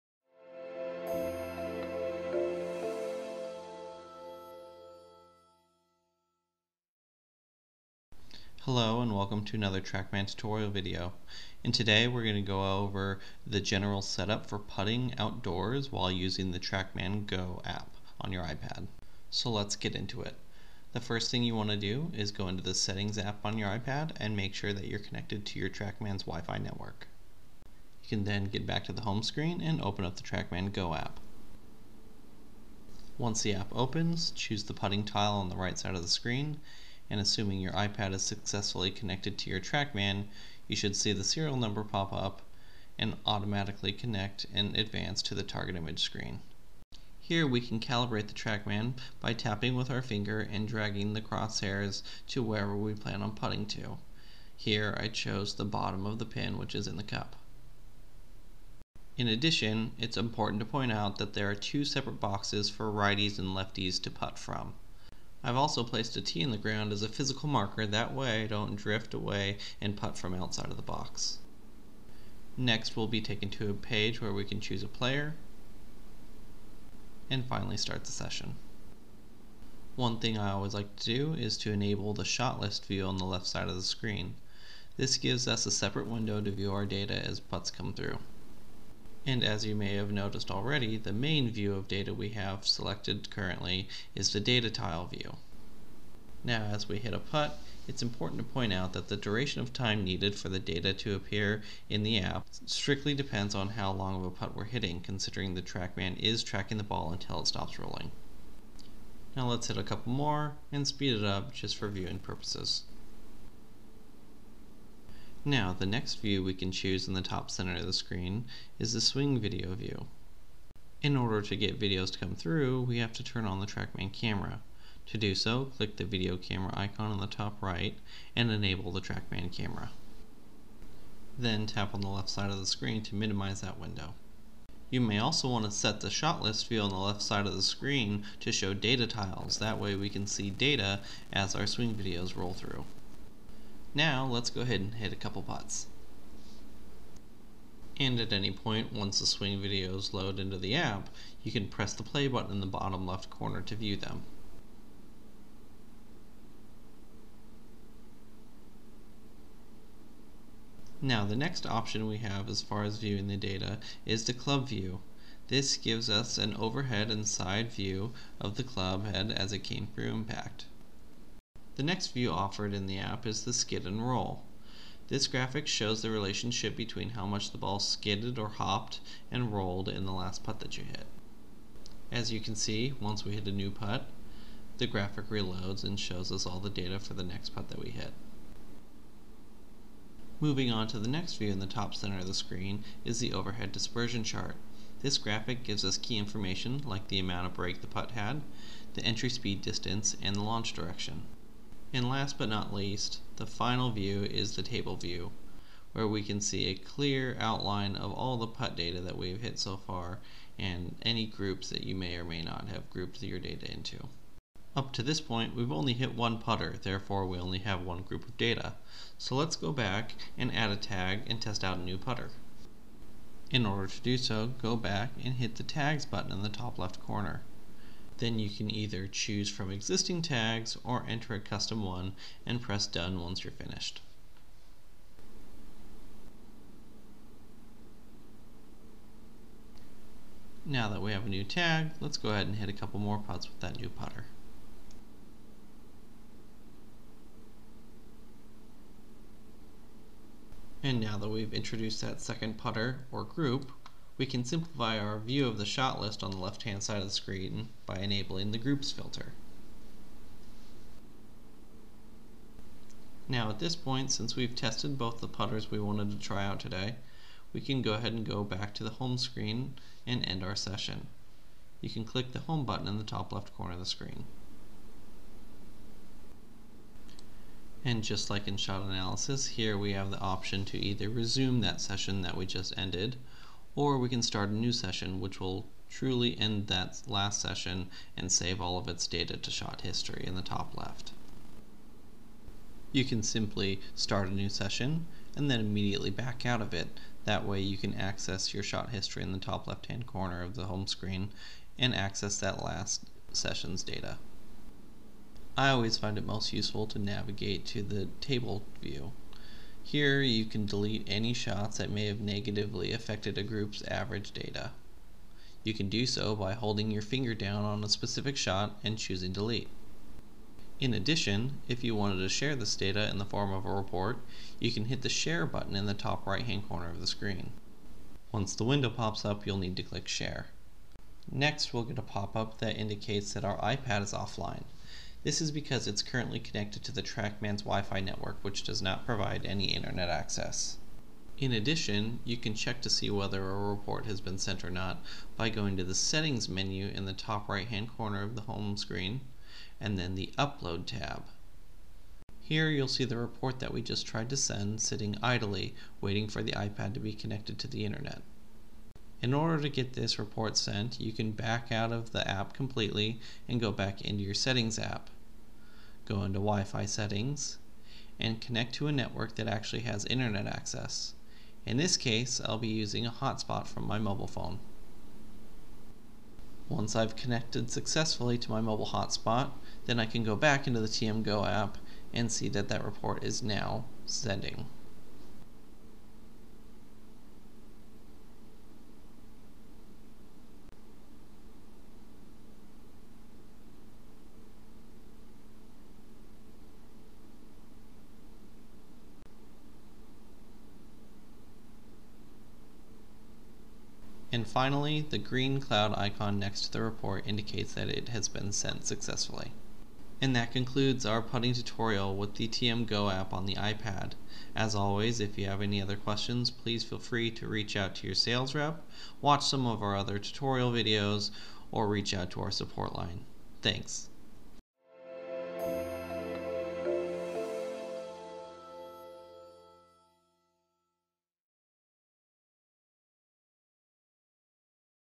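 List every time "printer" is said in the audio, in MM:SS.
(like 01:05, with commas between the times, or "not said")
not said.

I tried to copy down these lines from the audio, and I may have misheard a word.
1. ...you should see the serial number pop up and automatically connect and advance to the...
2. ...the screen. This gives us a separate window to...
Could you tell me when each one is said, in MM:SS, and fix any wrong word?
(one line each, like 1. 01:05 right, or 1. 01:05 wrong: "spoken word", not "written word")
1. 00:40 right
2. 01:23 right.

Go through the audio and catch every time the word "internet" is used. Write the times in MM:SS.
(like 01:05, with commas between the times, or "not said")
05:39, 05:57, 06:10.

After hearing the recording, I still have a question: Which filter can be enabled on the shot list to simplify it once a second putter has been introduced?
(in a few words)
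Groups filter.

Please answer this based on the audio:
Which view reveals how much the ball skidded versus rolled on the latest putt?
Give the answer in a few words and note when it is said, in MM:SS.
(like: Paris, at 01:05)
Skid and roll, at 02:53.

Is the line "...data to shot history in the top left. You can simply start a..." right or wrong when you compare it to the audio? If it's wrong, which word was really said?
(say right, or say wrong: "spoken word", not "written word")
right.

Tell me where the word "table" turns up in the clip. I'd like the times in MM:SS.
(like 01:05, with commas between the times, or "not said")
03:24, 05:08.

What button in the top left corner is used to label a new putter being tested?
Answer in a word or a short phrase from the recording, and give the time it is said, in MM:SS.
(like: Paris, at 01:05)
Tags button, at 03:45.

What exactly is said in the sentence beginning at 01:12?
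Next we'll be taken to a page where we can choose a player, and finally start the session.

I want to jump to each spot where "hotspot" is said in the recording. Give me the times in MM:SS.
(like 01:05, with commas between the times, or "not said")
06:13, 06:18.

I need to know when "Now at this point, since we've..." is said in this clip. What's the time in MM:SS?
04:23.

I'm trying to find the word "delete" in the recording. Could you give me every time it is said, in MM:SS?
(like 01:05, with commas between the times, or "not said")
05:10, 05:19.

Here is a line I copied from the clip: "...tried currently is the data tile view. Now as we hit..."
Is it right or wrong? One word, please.
wrong.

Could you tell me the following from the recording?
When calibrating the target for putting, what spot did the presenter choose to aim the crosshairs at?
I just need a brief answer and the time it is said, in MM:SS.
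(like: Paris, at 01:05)
Bottom of the pin, at 00:55.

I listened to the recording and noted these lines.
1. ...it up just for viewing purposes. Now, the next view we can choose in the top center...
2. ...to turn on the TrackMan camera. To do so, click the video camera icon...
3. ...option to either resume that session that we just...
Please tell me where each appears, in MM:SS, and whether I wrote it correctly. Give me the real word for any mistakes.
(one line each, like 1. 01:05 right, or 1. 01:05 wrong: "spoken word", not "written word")
1. 01:51 right
2. 02:03 right
3. 04:40 right.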